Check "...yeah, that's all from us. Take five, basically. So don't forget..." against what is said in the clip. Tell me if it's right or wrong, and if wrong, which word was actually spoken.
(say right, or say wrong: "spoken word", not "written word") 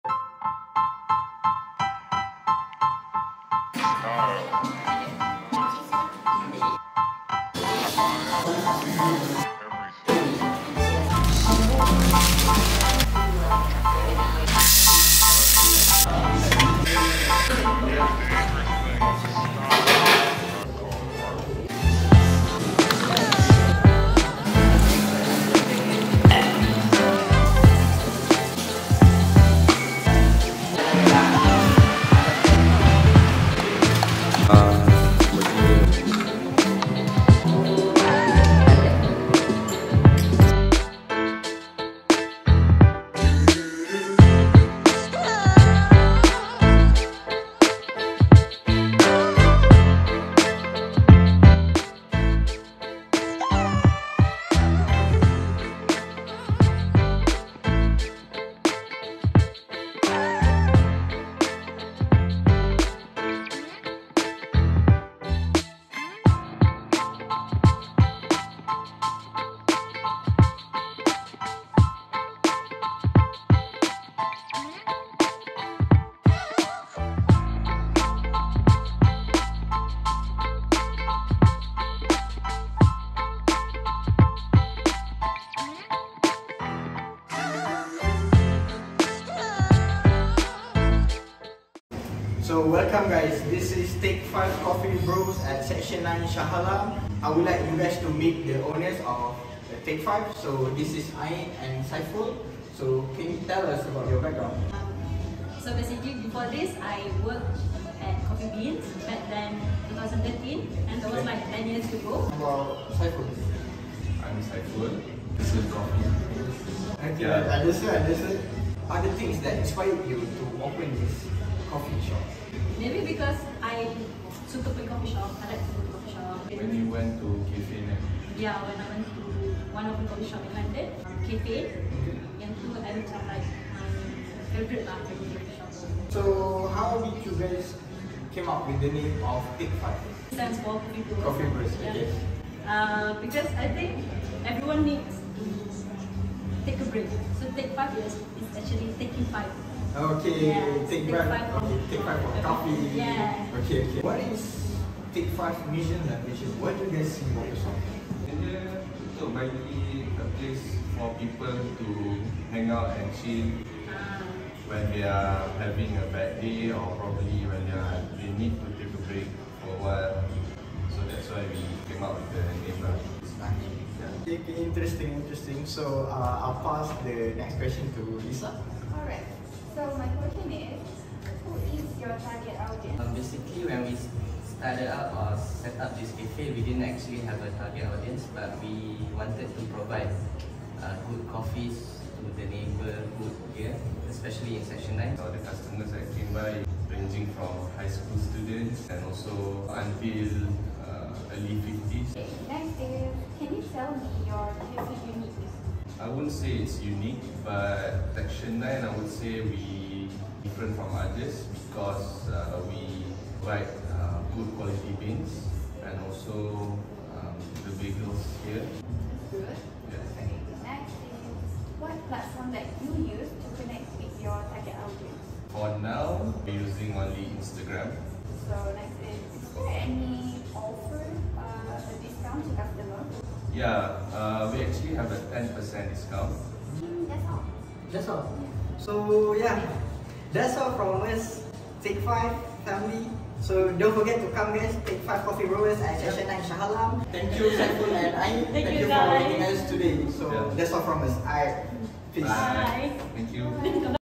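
wrong: "family", not "basically".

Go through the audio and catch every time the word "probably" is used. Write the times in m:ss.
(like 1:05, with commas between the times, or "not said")
2:46.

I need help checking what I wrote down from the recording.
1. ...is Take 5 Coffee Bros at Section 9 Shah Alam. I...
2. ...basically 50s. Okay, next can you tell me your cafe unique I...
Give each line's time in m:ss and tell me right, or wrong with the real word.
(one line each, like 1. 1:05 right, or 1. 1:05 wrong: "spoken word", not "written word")
1. 1:33 right
2. 3:21 wrong: "early", not "basically".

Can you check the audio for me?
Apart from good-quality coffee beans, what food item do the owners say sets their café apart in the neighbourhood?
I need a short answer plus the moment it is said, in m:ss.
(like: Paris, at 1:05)
Bagels, at 3:37.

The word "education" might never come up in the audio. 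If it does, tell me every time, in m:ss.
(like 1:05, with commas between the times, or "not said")
not said.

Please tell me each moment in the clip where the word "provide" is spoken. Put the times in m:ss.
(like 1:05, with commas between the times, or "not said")
3:09, 3:33.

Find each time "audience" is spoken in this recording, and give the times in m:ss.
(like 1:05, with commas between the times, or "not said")
3:02, 3:07, 3:44.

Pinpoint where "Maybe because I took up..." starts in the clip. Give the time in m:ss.
2:02.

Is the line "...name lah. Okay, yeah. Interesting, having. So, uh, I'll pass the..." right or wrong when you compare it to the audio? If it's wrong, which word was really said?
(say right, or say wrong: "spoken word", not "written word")
wrong: "interesting", not "having".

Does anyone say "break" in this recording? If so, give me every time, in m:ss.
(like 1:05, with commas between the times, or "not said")
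2:26, 2:49.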